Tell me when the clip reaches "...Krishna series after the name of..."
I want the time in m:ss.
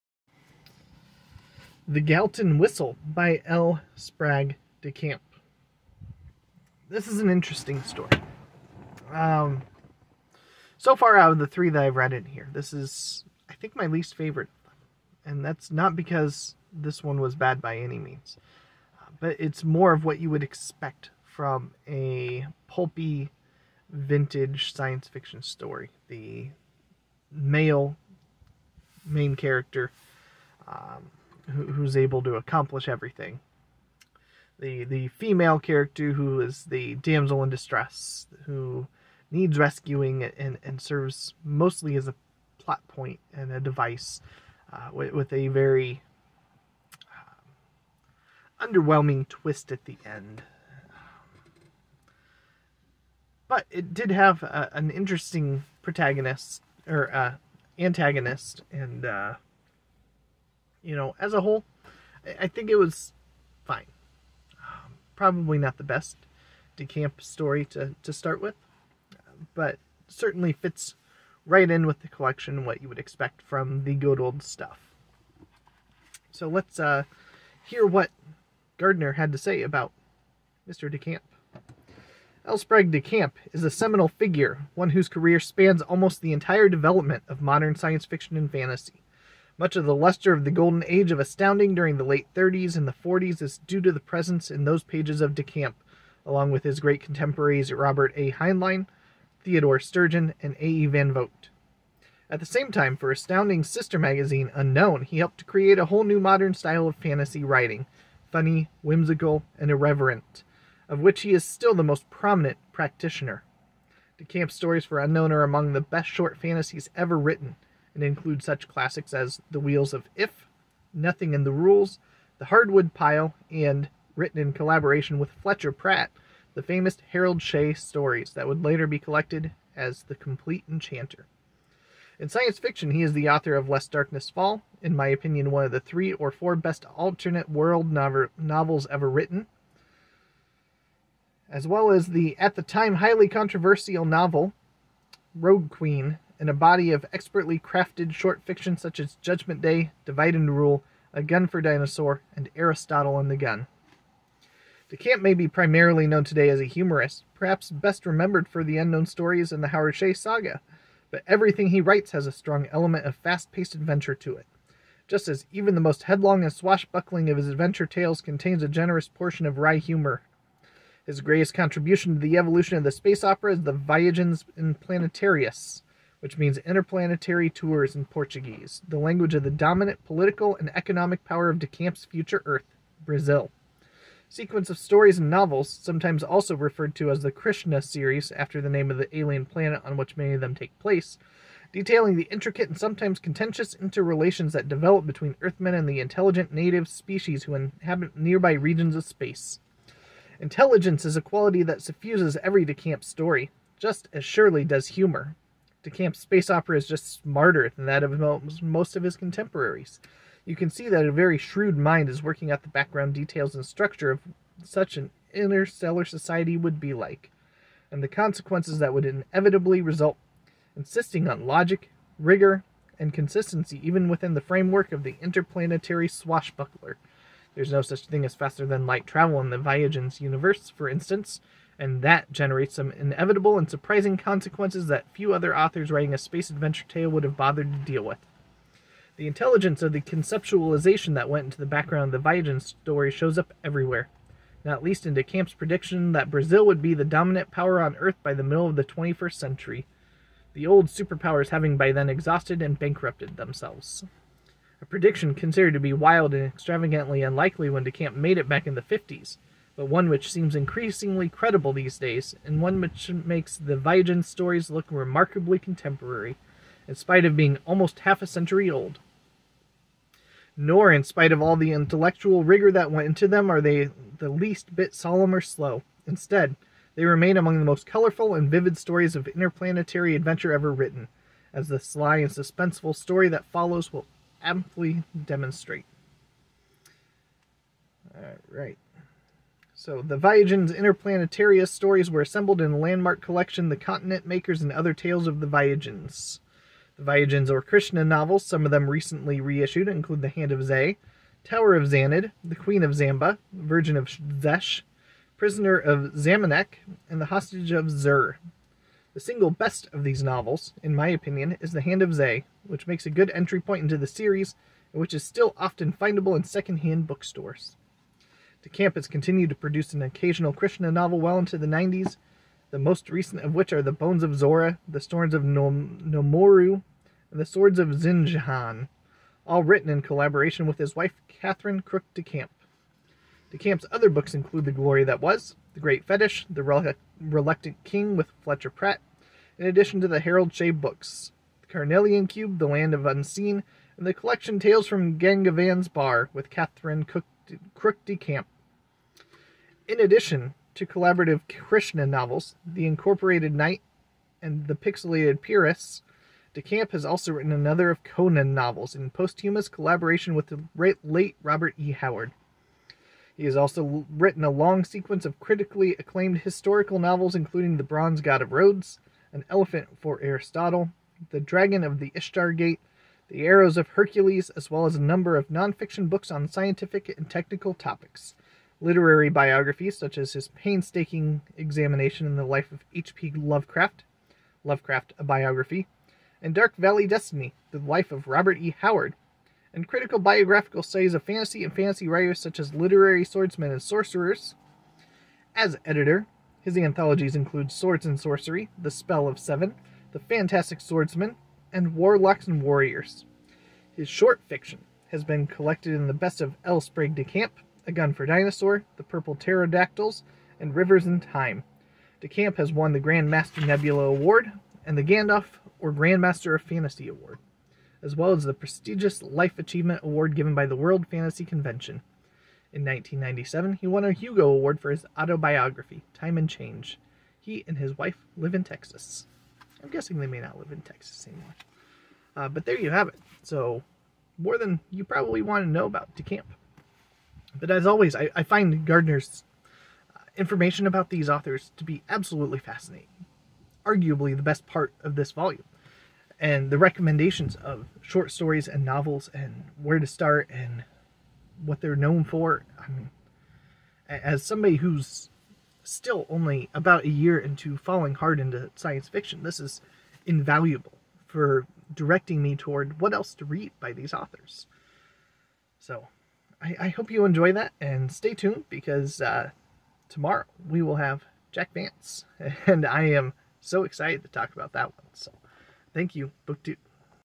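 3:07.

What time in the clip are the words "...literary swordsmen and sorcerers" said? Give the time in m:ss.
6:32.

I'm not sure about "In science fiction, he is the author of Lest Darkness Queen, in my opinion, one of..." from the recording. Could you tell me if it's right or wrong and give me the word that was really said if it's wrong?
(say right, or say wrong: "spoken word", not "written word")
wrong: "Fall", not "Queen".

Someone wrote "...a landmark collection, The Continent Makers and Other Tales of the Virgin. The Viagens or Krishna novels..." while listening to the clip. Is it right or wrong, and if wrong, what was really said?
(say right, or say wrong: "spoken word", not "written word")
wrong: "Viagens", not "Virgin".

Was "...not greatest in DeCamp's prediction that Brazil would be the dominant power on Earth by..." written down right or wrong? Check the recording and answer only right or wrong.
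wrong.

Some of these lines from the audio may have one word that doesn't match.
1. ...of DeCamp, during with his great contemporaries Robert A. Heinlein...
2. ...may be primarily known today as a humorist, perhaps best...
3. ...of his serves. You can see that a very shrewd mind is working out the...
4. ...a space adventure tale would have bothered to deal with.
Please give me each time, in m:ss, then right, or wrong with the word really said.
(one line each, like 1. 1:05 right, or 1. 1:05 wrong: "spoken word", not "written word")
1. 1:35 wrong: "along", not "during"
2. 2:35 right
3. 3:28 wrong: "contemporaries", not "serves"
4. 3:56 right.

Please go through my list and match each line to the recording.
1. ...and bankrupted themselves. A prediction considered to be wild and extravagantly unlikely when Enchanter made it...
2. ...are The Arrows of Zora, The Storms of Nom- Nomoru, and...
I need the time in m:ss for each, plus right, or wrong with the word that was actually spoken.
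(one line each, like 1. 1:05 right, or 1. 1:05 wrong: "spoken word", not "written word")
1. 4:12 wrong: "DeCamp", not "Enchanter"
2. 5:23 wrong: "Bones", not "Arrows".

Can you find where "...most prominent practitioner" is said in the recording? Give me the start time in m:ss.
1:51.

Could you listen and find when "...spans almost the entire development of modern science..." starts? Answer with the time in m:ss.
1:25.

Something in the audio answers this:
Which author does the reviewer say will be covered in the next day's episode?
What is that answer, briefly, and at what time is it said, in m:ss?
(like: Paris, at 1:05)
Jack Vance, at 7:51.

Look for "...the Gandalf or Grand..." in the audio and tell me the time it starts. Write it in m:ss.
6:54.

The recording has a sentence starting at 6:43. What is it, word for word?
His short fiction has been collected in the best of L.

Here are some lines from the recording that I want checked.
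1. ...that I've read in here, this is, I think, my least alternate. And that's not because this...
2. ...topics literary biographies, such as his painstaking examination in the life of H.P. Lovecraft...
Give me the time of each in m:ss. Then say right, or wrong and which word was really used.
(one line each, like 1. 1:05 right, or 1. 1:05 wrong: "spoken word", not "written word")
1. 0:11 wrong: "favorite", not "alternate"
2. 6:17 right.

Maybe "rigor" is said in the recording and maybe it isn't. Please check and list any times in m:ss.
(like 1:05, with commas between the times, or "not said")
3:42, 4:32.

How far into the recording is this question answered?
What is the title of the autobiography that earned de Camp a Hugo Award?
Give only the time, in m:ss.
7:06.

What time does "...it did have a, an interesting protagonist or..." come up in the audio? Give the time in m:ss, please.
0:53.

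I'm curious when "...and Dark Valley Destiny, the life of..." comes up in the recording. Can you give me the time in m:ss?
6:26.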